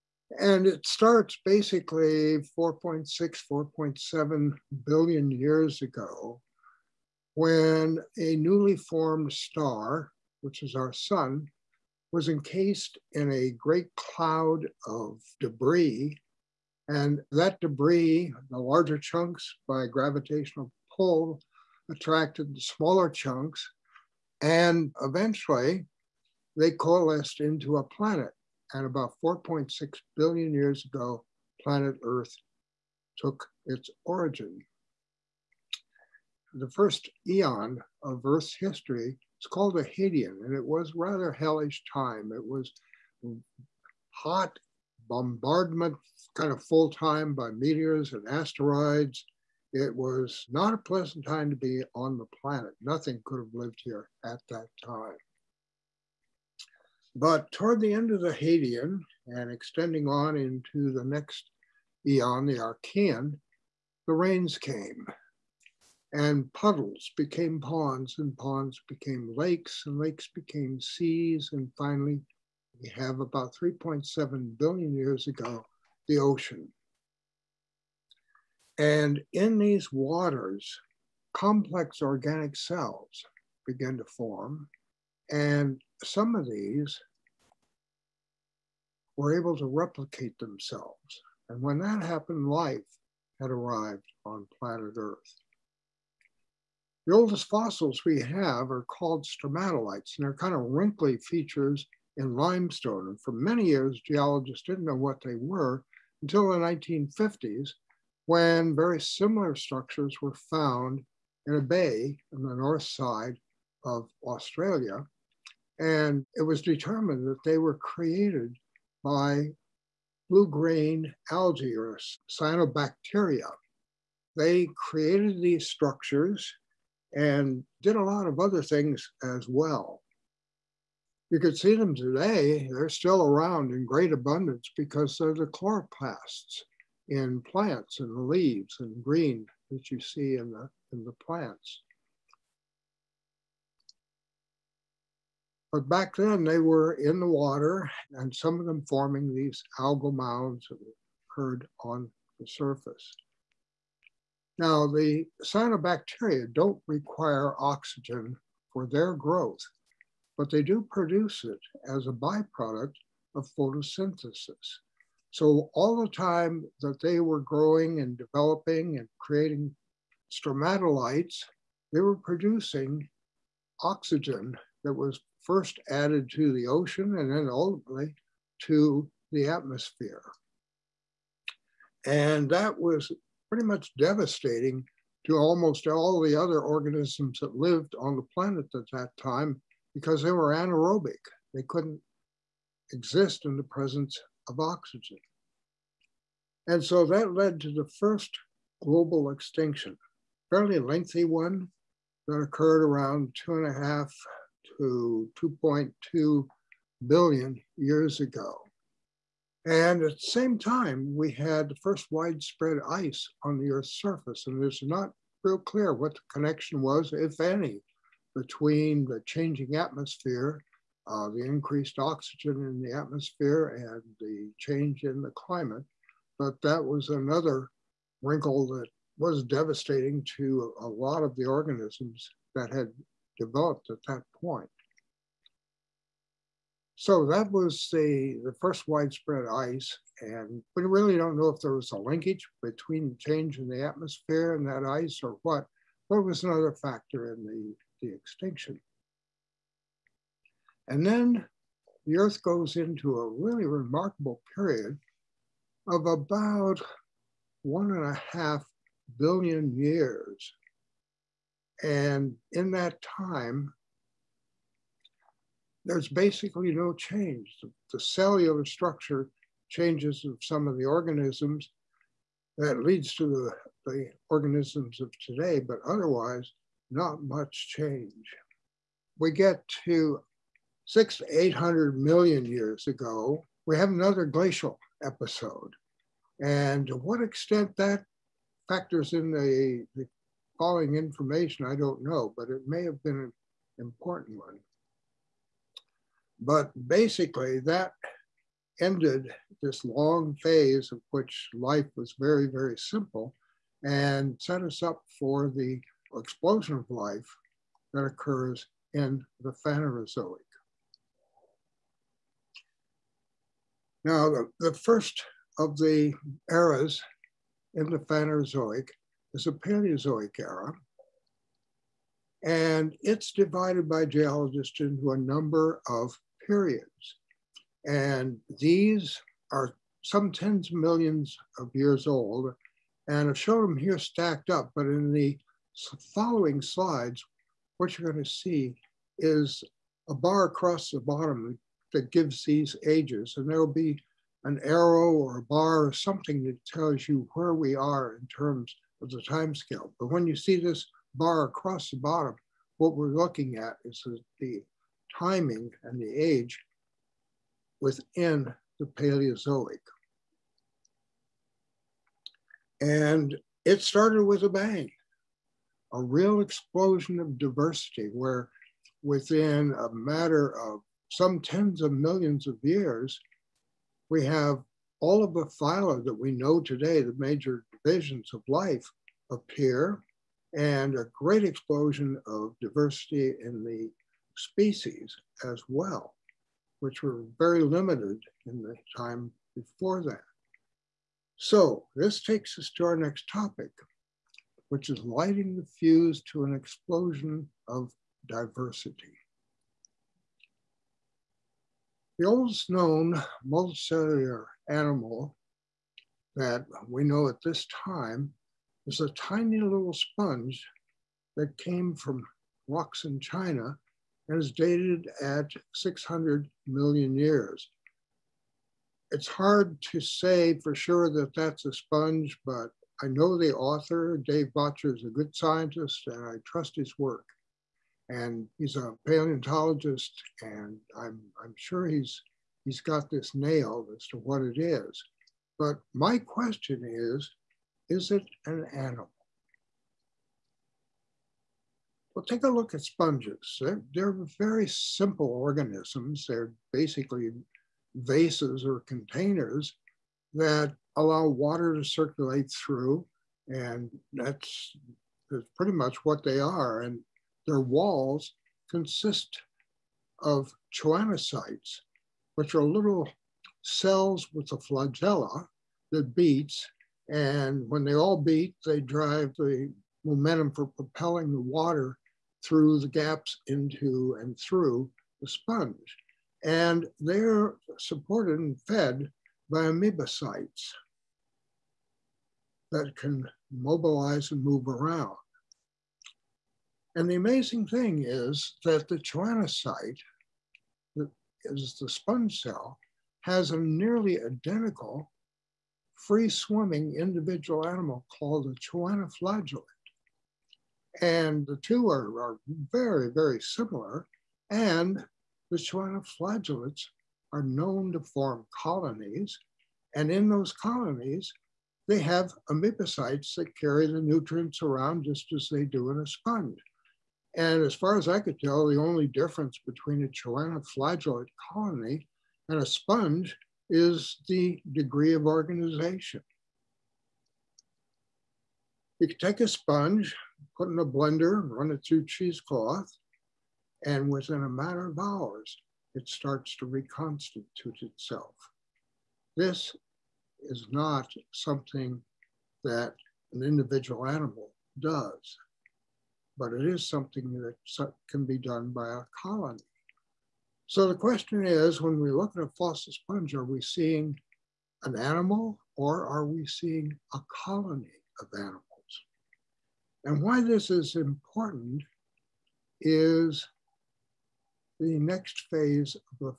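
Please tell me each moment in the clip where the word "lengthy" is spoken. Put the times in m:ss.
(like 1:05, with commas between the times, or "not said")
3:20.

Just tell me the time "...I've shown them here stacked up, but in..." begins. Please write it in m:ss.
5:33.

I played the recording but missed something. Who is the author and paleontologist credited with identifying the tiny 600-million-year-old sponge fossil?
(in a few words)
Dave Bottjer.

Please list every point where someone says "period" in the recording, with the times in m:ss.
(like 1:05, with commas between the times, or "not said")
4:14, 5:26.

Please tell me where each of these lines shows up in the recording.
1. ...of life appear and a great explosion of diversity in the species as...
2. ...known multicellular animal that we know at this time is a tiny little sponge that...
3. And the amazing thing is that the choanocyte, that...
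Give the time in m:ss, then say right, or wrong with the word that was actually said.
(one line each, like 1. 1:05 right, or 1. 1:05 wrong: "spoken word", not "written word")
1. 6:18 right
2. 6:42 right
3. 8:06 right.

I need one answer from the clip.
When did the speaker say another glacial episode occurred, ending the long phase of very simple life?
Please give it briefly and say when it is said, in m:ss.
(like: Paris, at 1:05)
600-800 million years ago, at 4:40.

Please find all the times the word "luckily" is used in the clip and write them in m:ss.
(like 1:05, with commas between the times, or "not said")
not said.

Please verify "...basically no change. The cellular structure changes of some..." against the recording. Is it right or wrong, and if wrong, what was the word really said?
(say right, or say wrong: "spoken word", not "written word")
right.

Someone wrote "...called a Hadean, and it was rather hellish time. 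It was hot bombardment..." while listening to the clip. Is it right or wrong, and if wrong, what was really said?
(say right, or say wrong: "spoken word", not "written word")
right.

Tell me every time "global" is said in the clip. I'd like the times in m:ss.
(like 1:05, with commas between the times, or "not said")
3:18.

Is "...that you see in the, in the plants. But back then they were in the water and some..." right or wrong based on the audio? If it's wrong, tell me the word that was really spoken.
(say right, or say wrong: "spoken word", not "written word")
right.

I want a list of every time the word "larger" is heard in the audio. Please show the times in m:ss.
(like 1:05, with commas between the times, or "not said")
0:18.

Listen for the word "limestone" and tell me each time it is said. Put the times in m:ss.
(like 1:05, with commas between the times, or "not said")
1:42.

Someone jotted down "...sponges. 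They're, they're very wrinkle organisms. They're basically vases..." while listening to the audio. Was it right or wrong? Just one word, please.
wrong.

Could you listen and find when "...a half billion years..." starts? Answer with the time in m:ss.
4:18.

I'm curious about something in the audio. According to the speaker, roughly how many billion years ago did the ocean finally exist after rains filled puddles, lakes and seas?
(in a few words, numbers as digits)
3.7 billion years.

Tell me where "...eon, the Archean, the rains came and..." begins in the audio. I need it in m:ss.
1:02.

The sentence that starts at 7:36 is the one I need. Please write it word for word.
And their walls consist of choanocytes, which are little cells with a flagella that beats.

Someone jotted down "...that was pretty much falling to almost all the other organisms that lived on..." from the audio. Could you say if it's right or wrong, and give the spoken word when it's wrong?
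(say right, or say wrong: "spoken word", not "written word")
wrong: "devastating", not "falling".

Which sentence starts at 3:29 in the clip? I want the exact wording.
And at the same time, we had the first widespread ice on the Earth's surface.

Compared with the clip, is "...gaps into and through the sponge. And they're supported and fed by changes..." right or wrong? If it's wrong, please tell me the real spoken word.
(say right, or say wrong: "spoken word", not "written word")
wrong: "amoebocytes", not "changes".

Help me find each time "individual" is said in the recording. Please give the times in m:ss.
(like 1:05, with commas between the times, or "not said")
8:16, 9:03.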